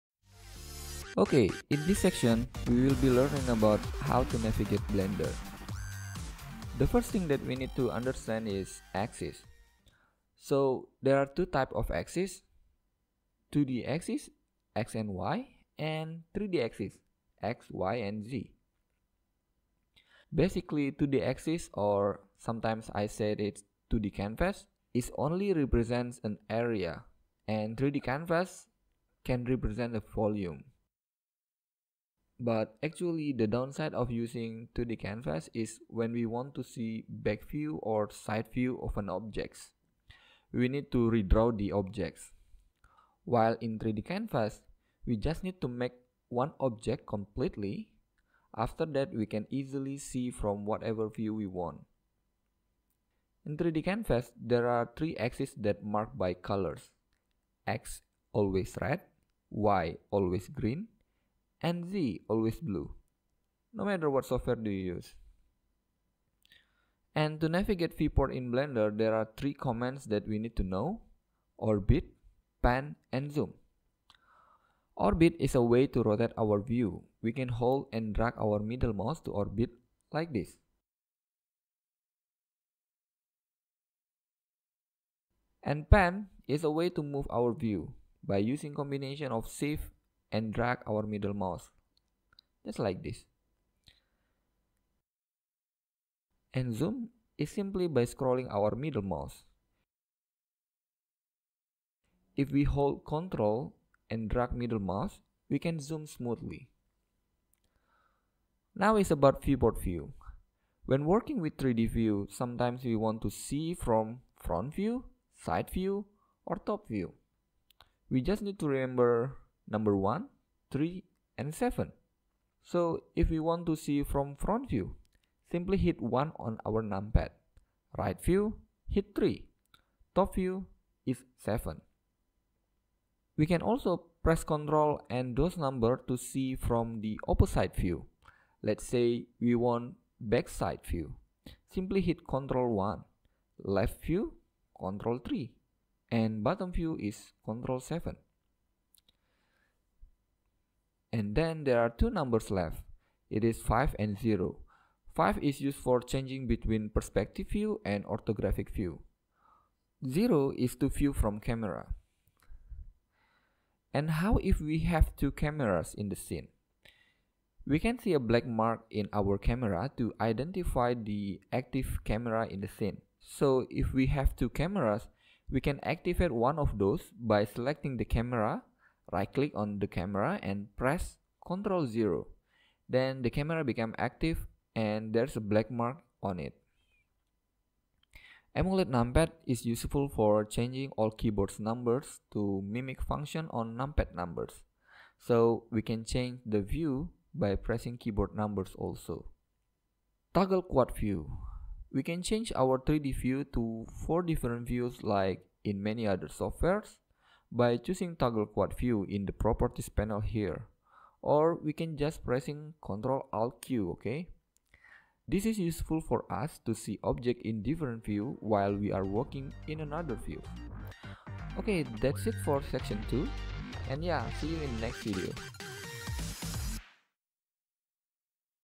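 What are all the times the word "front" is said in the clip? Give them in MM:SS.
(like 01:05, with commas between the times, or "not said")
01:54, 02:04.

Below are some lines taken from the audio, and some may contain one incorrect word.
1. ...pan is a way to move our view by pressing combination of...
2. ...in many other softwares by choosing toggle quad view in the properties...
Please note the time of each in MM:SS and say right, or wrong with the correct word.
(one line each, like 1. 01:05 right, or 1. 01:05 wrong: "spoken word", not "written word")
1. 01:25 wrong: "using", not "pressing"
2. 03:25 right.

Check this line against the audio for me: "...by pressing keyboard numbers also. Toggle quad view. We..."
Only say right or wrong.
right.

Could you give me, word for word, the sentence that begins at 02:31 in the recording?
And then there are two numbers left.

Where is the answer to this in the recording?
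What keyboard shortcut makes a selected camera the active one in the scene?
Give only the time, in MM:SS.
03:01.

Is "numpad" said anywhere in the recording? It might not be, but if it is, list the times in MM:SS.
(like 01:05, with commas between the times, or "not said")
02:06, 03:08, 03:13.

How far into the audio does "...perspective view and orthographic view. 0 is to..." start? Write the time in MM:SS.
02:36.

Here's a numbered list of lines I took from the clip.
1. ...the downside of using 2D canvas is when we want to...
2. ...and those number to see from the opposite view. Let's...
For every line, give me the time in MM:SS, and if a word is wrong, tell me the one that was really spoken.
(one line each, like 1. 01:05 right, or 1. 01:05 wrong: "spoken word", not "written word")
1. 00:33 right
2. 02:15 right.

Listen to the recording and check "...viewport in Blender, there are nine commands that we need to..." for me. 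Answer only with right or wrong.
wrong.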